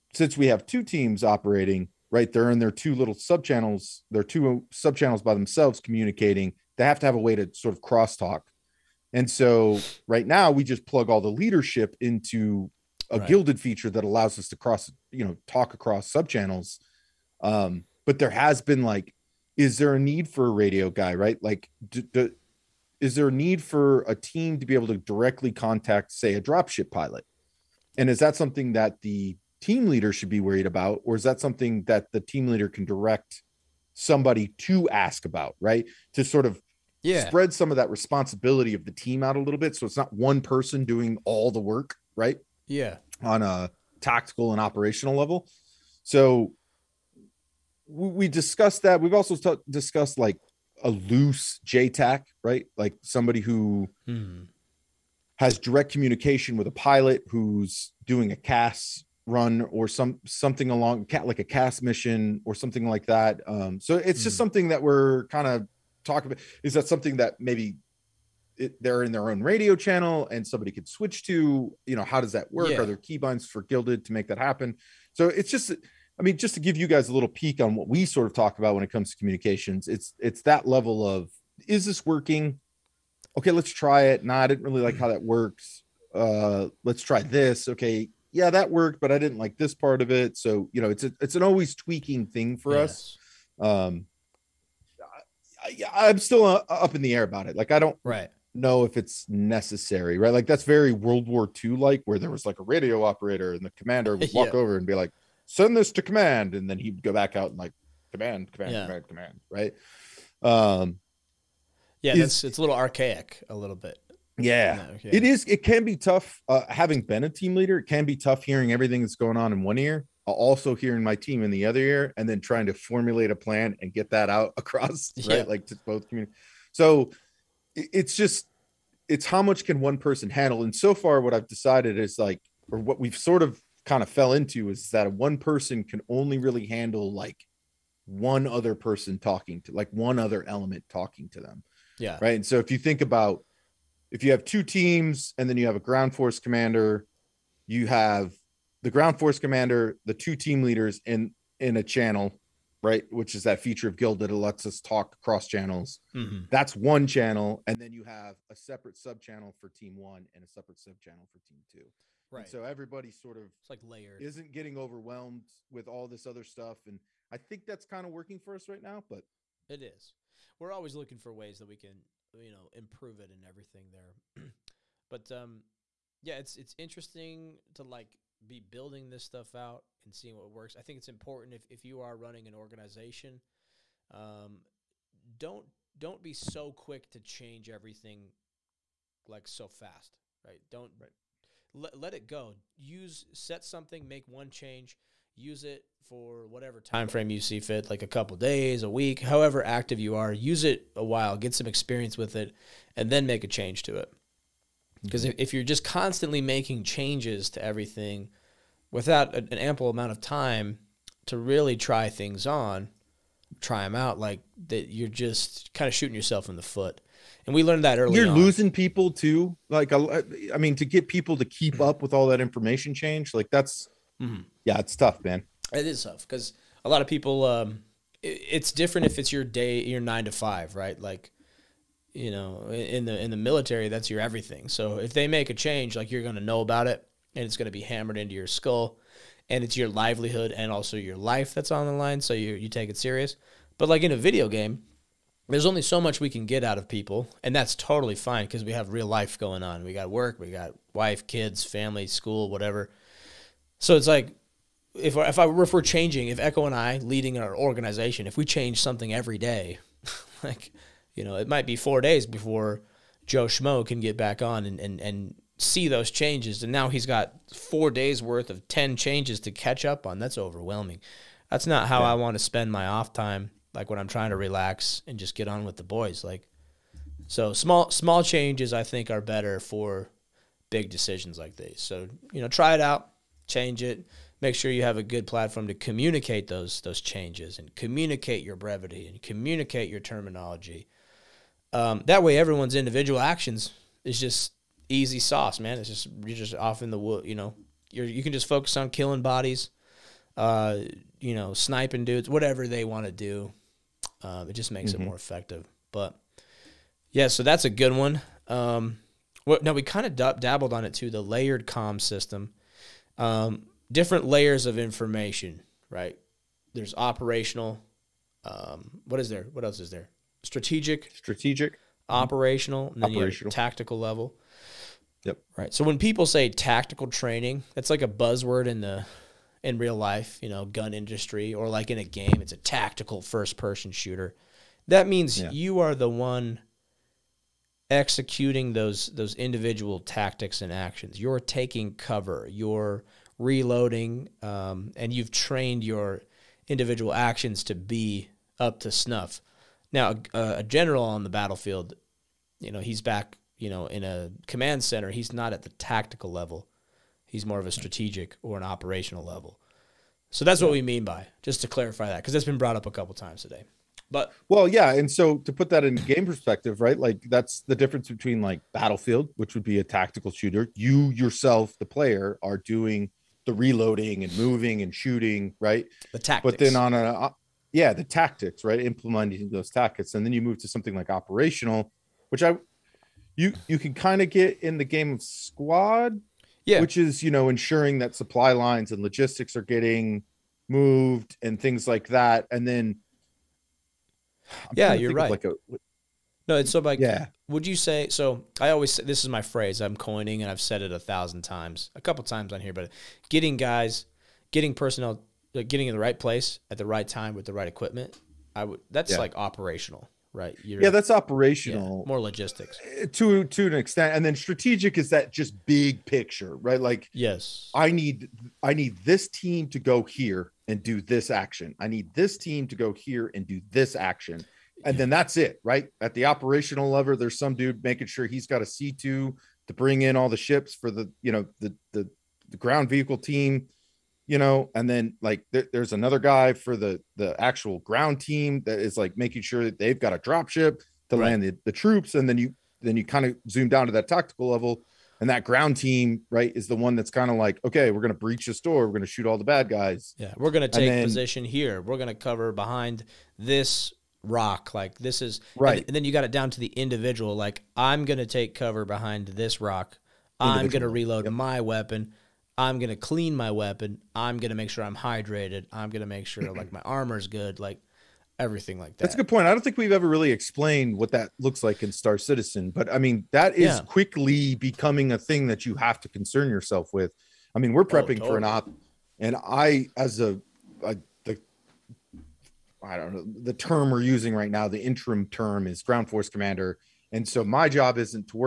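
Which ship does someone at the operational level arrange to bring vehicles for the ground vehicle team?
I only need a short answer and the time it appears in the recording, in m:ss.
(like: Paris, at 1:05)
C2, at 7:08.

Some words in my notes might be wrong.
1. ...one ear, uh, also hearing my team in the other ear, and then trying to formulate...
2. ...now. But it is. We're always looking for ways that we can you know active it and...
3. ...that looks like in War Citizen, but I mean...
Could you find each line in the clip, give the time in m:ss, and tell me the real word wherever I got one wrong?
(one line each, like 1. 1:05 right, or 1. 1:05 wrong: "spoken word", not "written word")
1. 1:59 right
2. 2:48 wrong: "improve", not "active"
3. 7:51 wrong: "Star", not "War".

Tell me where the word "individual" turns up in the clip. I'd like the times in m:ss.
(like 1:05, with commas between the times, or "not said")
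4:52, 5:39, 5:46, 7:36.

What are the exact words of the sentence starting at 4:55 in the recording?
It's just you're just off in the wood, you know.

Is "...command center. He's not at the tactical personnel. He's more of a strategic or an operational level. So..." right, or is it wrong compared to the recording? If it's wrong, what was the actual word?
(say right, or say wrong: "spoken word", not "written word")
wrong: "level", not "personnel".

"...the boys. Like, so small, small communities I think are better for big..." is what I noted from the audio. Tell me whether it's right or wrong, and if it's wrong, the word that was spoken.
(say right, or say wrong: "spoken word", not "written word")
wrong: "changes", not "communities".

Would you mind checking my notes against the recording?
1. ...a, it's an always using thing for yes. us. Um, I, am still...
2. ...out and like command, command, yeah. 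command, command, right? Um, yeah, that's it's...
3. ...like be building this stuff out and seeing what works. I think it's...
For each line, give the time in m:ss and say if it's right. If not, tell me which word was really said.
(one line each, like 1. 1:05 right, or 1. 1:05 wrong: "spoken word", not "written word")
1. 1:31 wrong: "tweaking", not "using"
2. 1:47 right
3. 2:57 right.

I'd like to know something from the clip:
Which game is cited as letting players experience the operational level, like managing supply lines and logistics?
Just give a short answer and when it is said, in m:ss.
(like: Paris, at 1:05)
Squad, at 6:25.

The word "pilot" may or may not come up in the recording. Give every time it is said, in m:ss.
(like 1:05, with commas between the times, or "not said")
0:26, 0:56.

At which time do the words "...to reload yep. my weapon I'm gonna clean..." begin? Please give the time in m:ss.
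7:40.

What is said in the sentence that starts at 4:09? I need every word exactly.
We got work, we got wife, kids, family, school, whatever.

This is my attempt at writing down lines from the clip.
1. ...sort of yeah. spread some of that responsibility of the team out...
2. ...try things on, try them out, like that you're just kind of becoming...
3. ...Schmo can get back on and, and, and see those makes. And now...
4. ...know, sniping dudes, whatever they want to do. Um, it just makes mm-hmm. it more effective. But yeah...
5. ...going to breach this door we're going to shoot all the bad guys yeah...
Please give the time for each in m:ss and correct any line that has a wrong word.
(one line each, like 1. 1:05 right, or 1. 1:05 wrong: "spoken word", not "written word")
1. 0:36 right
2. 3:31 wrong: "shooting", not "becoming"
3. 4:23 wrong: "changes", not "makes"
4. 5:01 right
5. 7:28 right.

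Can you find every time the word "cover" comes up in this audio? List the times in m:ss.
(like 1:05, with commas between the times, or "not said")
5:41, 7:32, 7:38.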